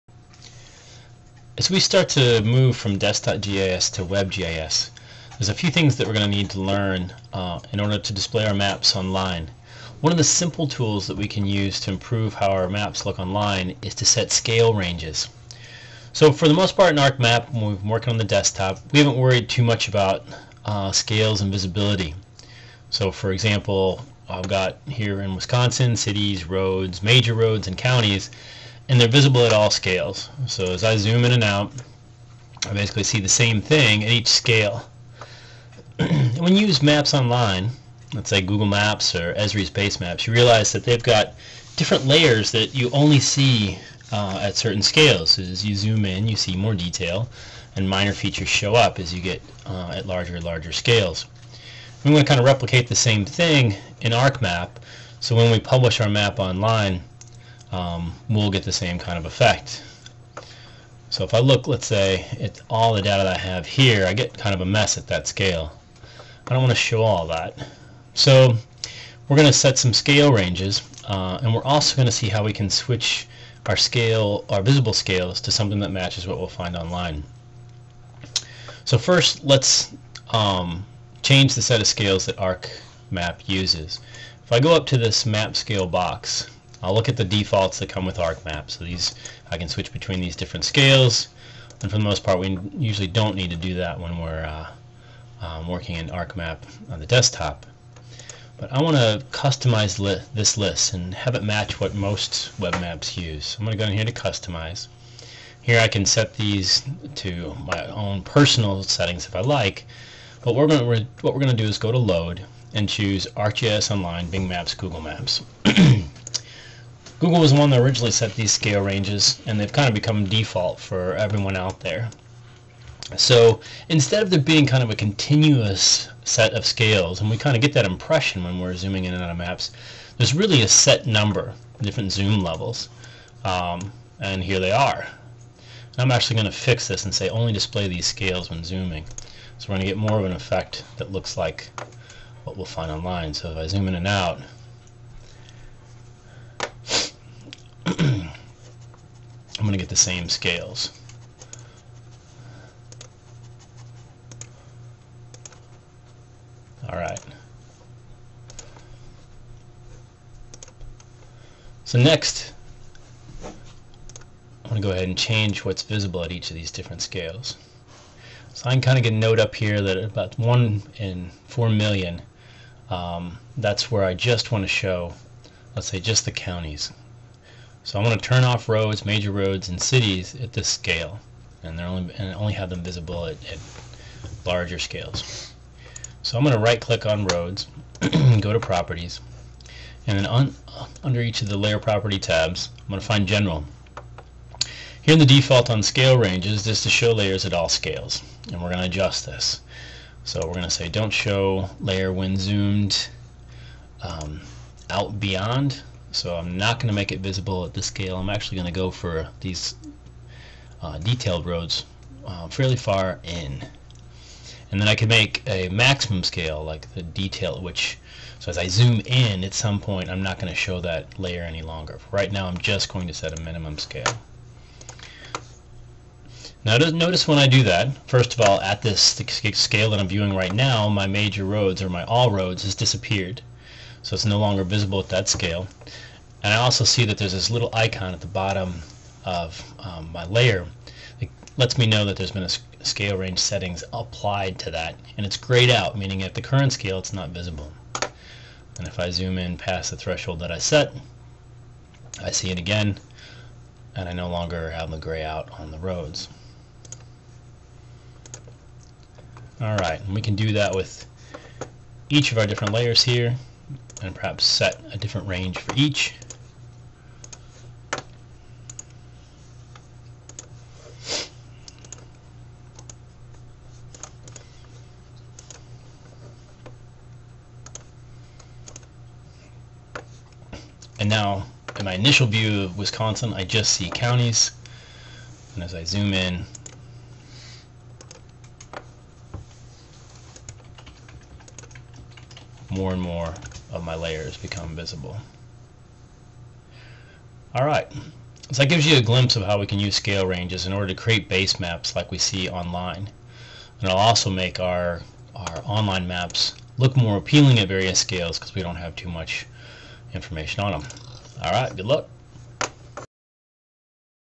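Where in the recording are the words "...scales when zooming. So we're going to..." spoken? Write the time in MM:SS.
02:18.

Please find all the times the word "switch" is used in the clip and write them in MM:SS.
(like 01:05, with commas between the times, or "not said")
01:12, 01:29.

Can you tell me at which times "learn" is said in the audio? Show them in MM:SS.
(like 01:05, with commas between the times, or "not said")
00:06.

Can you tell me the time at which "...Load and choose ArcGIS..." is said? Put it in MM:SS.
01:51.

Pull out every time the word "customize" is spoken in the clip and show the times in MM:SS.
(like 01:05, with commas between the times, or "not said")
01:39, 01:44.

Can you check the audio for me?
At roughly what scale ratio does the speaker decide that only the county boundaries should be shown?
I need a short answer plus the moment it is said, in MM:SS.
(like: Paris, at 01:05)
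1 in 4 million, at 02:50.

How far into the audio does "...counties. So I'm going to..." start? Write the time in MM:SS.
02:56.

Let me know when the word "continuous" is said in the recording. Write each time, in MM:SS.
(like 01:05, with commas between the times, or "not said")
02:04.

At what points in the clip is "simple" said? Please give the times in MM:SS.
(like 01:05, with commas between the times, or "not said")
00:10.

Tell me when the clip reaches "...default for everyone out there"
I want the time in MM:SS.
02:00.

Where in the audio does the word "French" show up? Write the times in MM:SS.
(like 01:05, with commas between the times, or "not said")
not said.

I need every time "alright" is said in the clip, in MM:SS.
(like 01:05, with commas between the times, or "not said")
02:36, 04:19, 04:57, 05:11.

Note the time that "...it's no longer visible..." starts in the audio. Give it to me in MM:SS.
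03:54.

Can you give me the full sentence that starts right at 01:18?
So first, let's um, change the set of scales that ArcMap uses.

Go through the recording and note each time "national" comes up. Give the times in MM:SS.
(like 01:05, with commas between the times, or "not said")
not said.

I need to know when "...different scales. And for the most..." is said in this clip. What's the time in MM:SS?
01:30.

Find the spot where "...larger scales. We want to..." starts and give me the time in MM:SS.
00:50.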